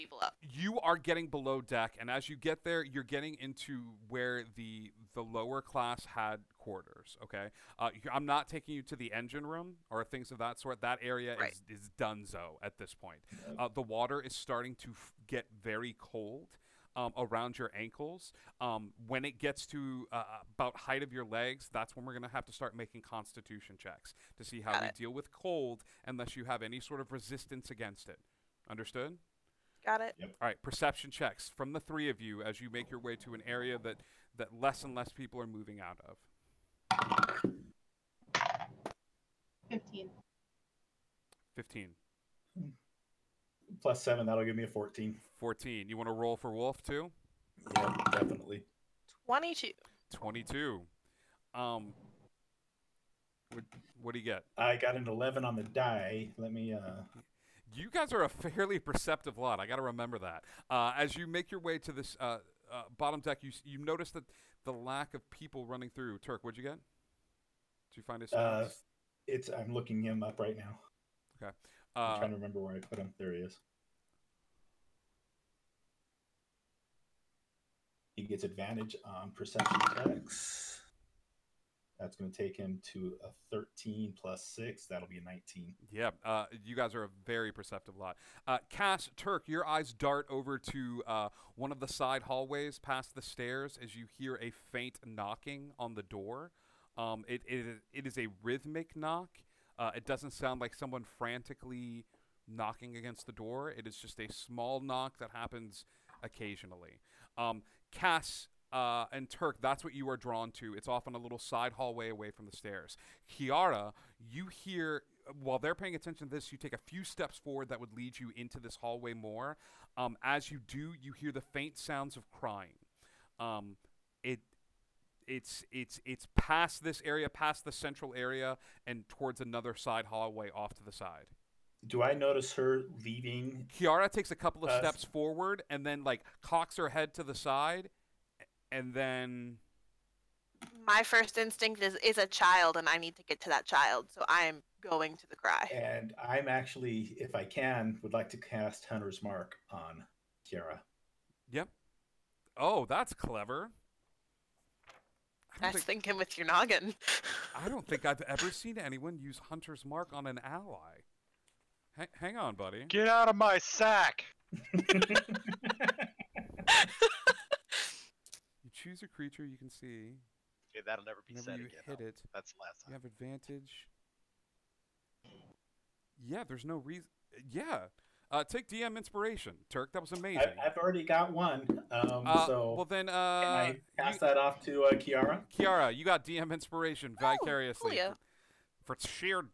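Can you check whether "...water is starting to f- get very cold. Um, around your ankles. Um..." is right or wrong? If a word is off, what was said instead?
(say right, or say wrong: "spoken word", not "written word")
right.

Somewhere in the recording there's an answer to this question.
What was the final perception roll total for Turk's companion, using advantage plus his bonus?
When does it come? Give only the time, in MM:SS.
01:24.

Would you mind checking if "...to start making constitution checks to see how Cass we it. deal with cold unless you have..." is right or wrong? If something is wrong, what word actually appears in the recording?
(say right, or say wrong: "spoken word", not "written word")
wrong: "Got", not "Cass".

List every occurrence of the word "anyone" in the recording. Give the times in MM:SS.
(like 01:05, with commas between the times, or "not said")
02:38.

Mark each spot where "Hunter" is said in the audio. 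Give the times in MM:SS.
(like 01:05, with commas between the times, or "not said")
02:28, 02:39.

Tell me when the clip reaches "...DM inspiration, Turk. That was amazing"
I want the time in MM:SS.
02:58.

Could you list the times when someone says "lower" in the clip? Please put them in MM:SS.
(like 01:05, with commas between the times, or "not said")
00:05.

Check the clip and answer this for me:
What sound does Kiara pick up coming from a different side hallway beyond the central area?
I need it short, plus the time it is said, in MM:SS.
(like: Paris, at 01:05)
Crying, at 02:01.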